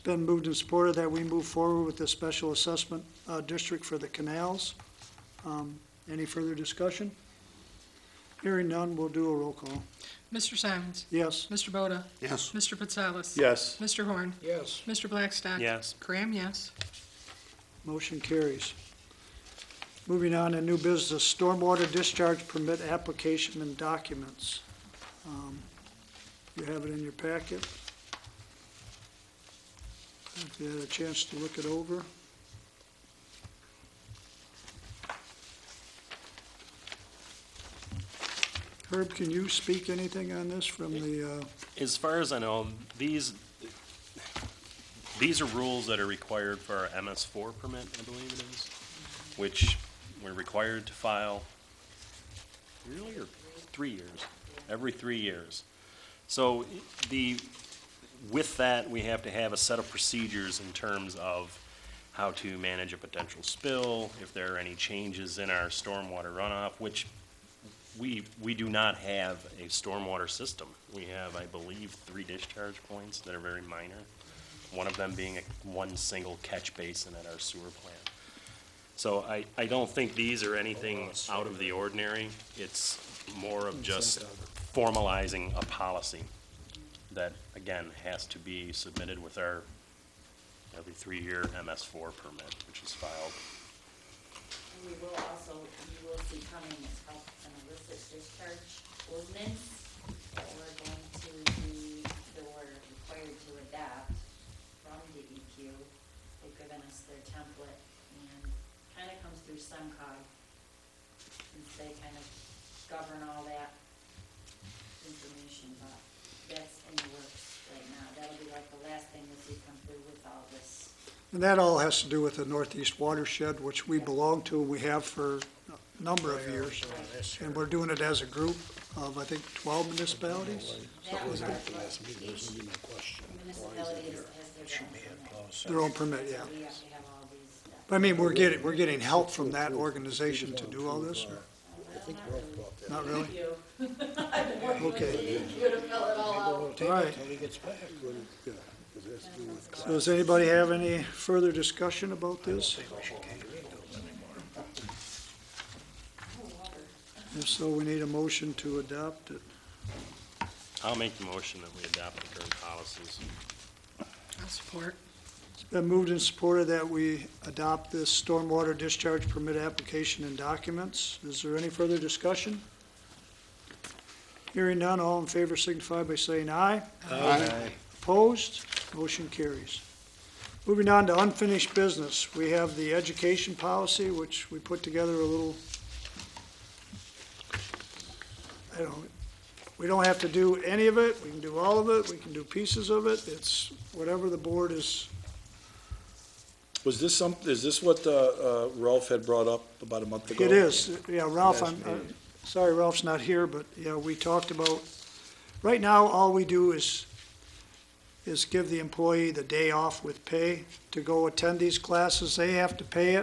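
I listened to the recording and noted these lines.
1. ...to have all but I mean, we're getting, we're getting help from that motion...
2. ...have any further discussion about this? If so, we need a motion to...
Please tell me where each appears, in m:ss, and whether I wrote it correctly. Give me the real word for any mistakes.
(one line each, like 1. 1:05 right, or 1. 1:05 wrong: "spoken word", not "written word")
1. 2:16 wrong: "organization", not "motion"
2. 2:30 right.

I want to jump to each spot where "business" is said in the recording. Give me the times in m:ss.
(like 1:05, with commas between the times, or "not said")
0:20, 3:01.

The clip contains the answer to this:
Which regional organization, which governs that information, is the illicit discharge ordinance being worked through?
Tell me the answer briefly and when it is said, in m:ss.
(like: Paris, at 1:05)
SEMCOG, at 1:49.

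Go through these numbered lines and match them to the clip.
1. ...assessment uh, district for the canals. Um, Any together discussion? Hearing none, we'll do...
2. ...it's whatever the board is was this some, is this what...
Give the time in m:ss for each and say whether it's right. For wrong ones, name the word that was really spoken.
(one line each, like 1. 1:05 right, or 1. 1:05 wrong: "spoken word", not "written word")
1. 0:02 wrong: "further", not "together"
2. 3:13 right.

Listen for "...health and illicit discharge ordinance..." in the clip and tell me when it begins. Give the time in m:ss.
1:37.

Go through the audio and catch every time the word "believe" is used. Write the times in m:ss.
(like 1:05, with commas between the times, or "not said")
0:48, 1:11.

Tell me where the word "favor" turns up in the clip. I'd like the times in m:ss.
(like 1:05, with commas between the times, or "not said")
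2:55.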